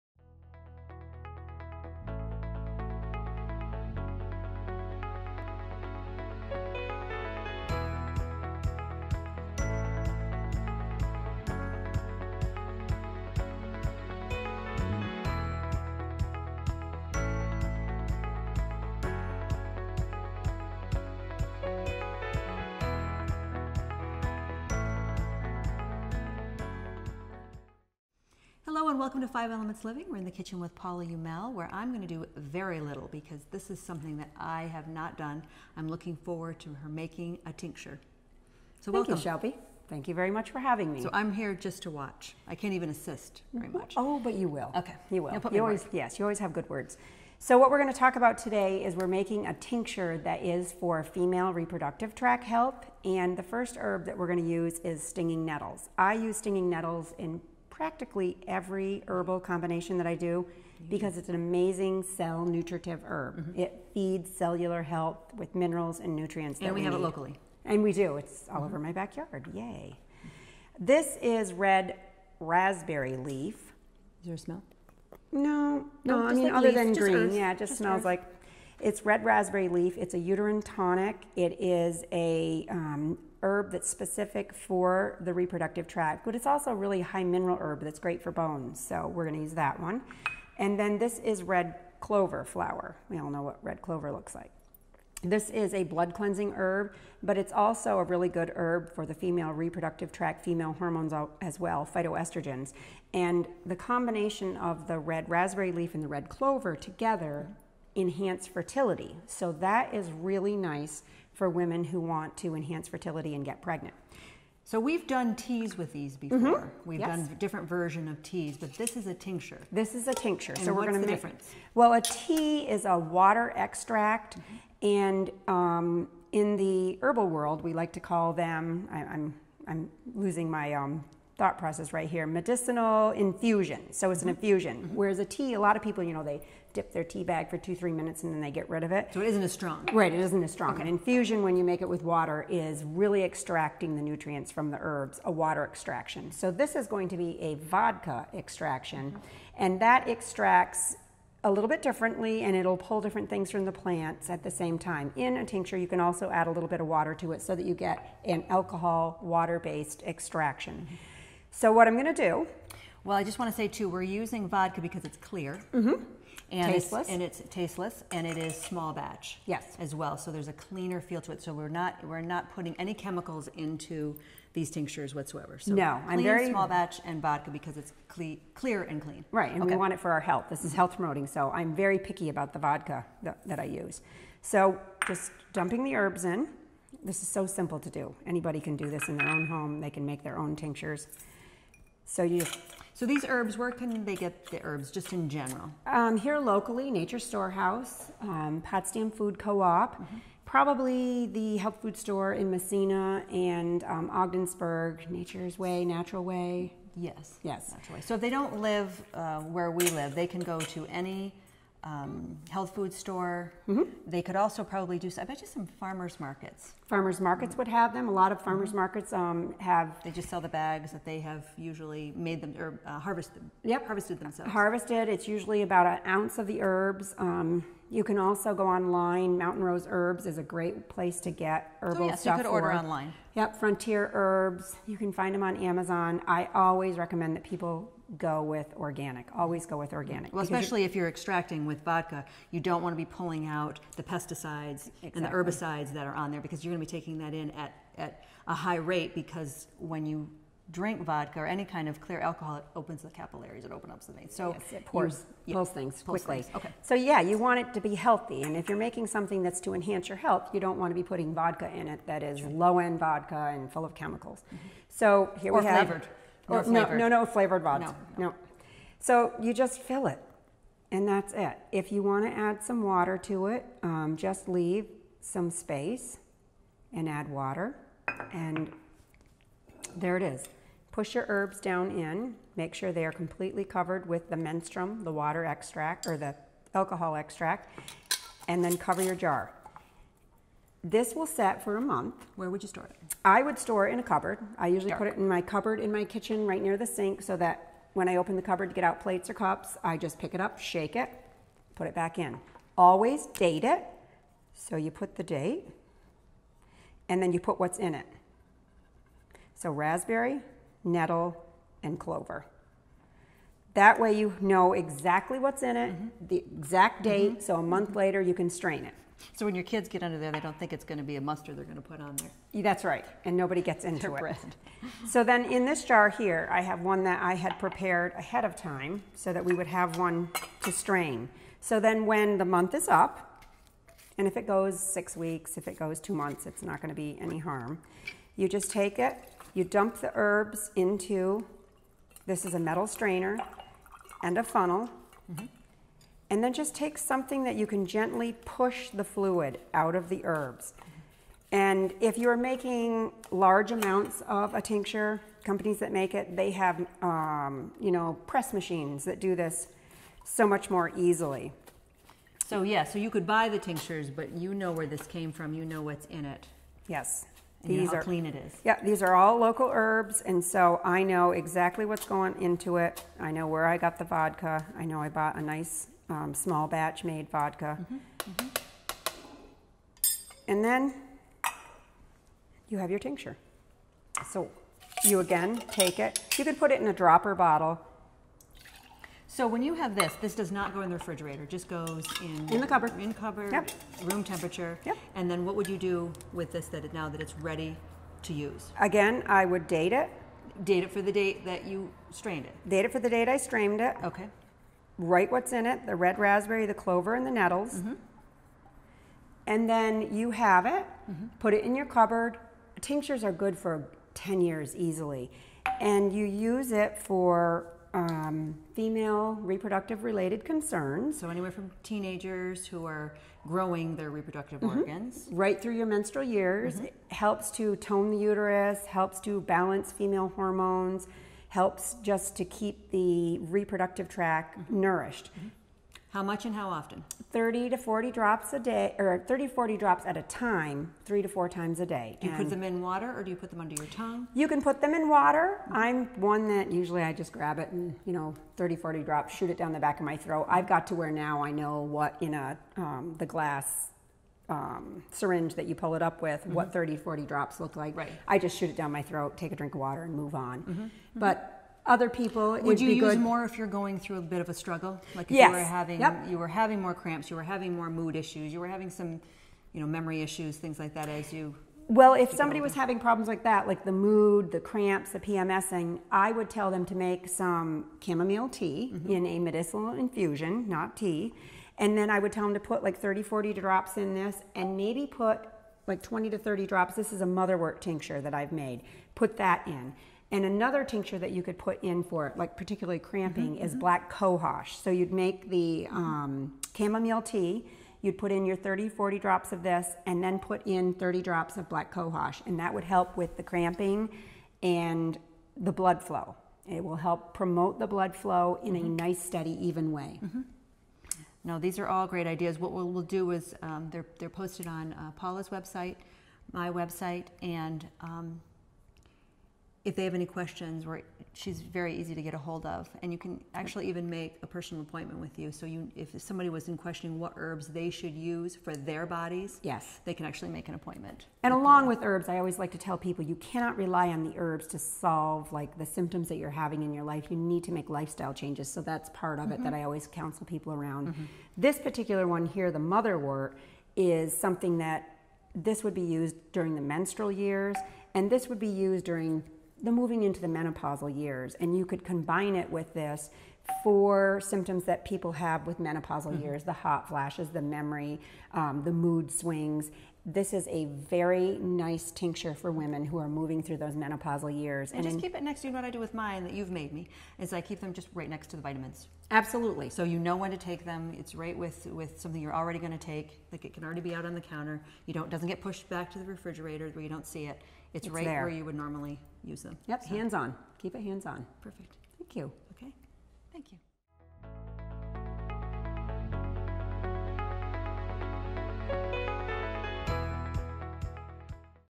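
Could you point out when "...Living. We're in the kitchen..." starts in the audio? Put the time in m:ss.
0:29.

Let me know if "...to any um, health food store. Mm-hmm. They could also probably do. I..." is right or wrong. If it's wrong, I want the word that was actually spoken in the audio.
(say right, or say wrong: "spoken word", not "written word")
right.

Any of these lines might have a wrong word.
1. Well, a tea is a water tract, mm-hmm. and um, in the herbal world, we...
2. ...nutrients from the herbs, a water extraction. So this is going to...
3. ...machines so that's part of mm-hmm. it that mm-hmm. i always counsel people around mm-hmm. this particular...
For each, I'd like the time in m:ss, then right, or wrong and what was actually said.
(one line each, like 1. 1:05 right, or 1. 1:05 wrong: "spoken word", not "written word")
1. 2:01 wrong: "extract", not "tract"
2. 2:24 right
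3. 8:58 wrong: "changes", not "machines".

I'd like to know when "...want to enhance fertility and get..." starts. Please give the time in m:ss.
1:51.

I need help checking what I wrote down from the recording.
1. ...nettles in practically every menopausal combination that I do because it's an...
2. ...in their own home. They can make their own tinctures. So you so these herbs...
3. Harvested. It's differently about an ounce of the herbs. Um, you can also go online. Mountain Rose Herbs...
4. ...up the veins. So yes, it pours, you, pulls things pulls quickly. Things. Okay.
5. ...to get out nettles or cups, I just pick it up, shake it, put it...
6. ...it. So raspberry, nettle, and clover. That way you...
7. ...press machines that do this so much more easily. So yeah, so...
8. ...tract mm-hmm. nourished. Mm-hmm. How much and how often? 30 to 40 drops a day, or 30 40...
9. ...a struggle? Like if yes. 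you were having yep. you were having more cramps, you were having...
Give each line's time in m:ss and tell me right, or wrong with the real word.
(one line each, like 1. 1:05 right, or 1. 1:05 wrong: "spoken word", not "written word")
1. 0:56 wrong: "herbal", not "menopausal"
2. 3:09 right
3. 3:44 wrong: "usually", not "differently"
4. 4:13 right
5. 4:58 wrong: "plates", not "nettles"
6. 5:07 right
7. 5:58 right
8. 7:14 right
9. 7:44 right.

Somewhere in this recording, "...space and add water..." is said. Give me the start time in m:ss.
4:35.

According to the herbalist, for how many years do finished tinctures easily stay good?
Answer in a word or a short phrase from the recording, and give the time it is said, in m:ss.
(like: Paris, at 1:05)
10 years, at 6:54.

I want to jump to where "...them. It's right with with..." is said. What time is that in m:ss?
9:30.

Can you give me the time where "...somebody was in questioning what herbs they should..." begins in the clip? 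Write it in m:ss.
8:46.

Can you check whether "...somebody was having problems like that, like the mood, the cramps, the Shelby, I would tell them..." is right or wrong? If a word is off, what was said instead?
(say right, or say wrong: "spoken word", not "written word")
wrong: "PMSing", not "Shelby".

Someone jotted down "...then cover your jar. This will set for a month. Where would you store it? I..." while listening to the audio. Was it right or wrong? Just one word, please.
right.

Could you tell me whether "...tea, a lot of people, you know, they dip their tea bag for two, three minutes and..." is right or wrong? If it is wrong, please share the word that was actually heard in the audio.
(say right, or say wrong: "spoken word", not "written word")
right.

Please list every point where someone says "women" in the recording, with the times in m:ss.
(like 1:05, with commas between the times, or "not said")
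1:51, 9:22.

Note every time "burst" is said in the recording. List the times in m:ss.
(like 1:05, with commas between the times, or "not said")
not said.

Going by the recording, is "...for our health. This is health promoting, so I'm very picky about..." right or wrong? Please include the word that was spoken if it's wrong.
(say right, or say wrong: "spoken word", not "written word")
right.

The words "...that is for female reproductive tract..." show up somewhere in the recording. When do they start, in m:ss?
0:50.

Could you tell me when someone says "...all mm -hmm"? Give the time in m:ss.
1:08.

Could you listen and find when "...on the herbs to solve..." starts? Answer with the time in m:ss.
8:54.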